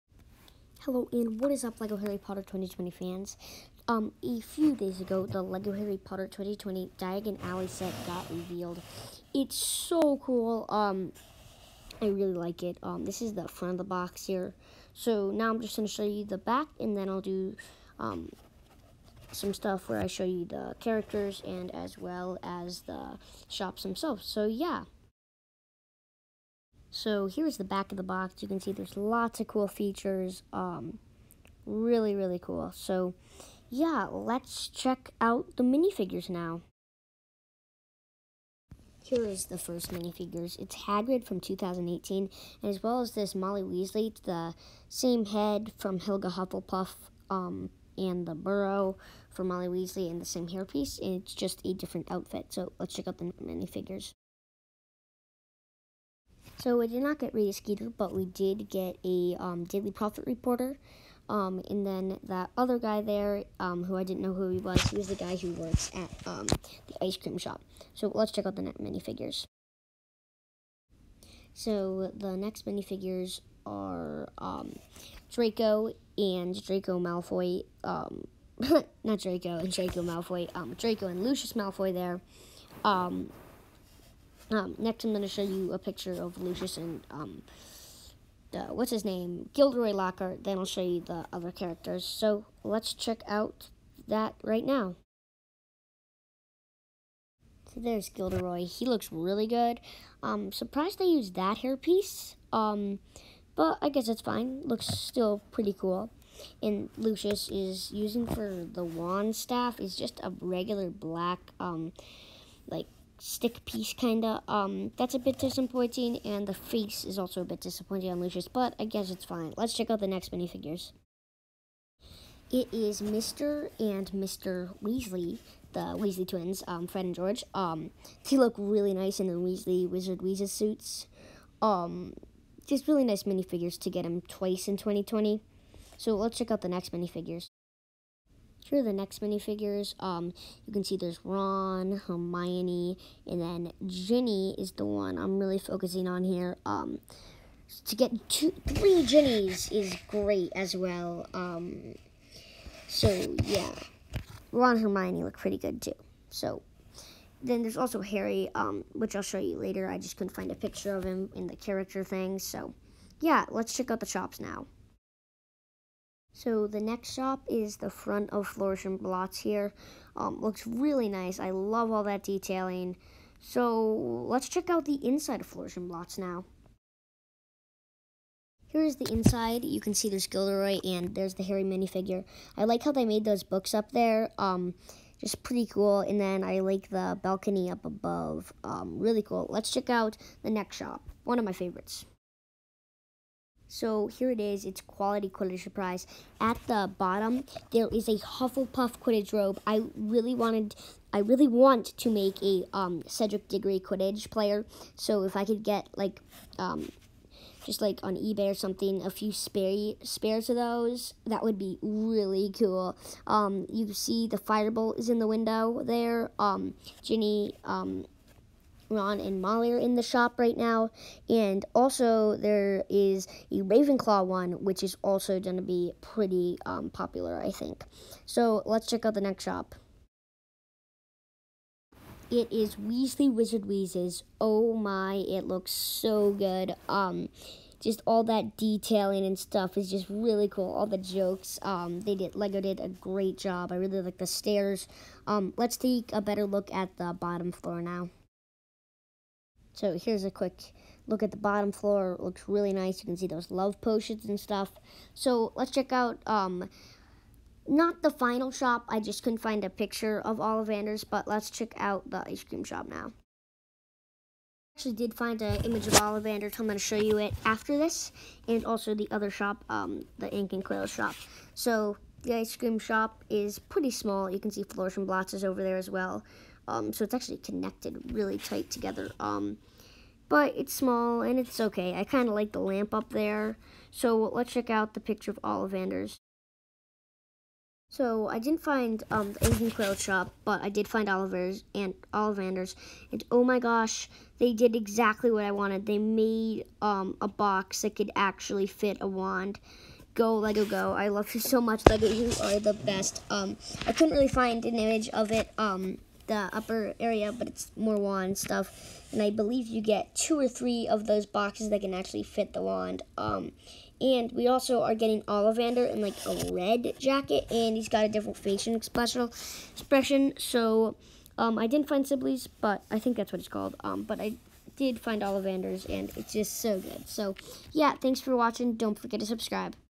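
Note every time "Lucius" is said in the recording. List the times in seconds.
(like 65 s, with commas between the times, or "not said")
81 s, 86 s, 106 s, 118 s.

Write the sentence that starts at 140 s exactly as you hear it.
Um, you can see there's Ron, Hermione, and then Ginny is the one I'm really focusing on here.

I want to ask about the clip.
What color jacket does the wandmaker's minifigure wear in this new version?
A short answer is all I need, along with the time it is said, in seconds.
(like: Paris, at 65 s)
Red, at 316 s.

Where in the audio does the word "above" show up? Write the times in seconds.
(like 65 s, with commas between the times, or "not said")
187 s.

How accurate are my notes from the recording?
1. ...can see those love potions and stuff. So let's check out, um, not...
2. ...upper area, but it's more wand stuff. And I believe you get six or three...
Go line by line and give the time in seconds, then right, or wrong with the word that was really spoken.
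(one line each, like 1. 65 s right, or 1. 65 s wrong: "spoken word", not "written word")
1. 253 s right
2. 306 s wrong: "two", not "six".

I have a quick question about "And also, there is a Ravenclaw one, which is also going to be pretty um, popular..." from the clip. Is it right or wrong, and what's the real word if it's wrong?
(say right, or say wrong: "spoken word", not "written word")
right.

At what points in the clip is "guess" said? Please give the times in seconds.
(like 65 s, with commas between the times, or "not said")
103 s, 118 s.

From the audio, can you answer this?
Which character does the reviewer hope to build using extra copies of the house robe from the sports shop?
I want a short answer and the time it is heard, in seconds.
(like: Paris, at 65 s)
Cedric Diggory, at 203 s.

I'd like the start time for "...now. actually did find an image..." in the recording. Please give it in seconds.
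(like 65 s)
262 s.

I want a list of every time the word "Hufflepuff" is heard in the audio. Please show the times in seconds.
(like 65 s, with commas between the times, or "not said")
46 s, 198 s.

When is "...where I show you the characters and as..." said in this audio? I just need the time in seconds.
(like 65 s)
19 s.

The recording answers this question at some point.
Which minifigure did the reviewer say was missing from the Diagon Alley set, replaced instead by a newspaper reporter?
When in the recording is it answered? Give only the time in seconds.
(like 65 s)
57 s.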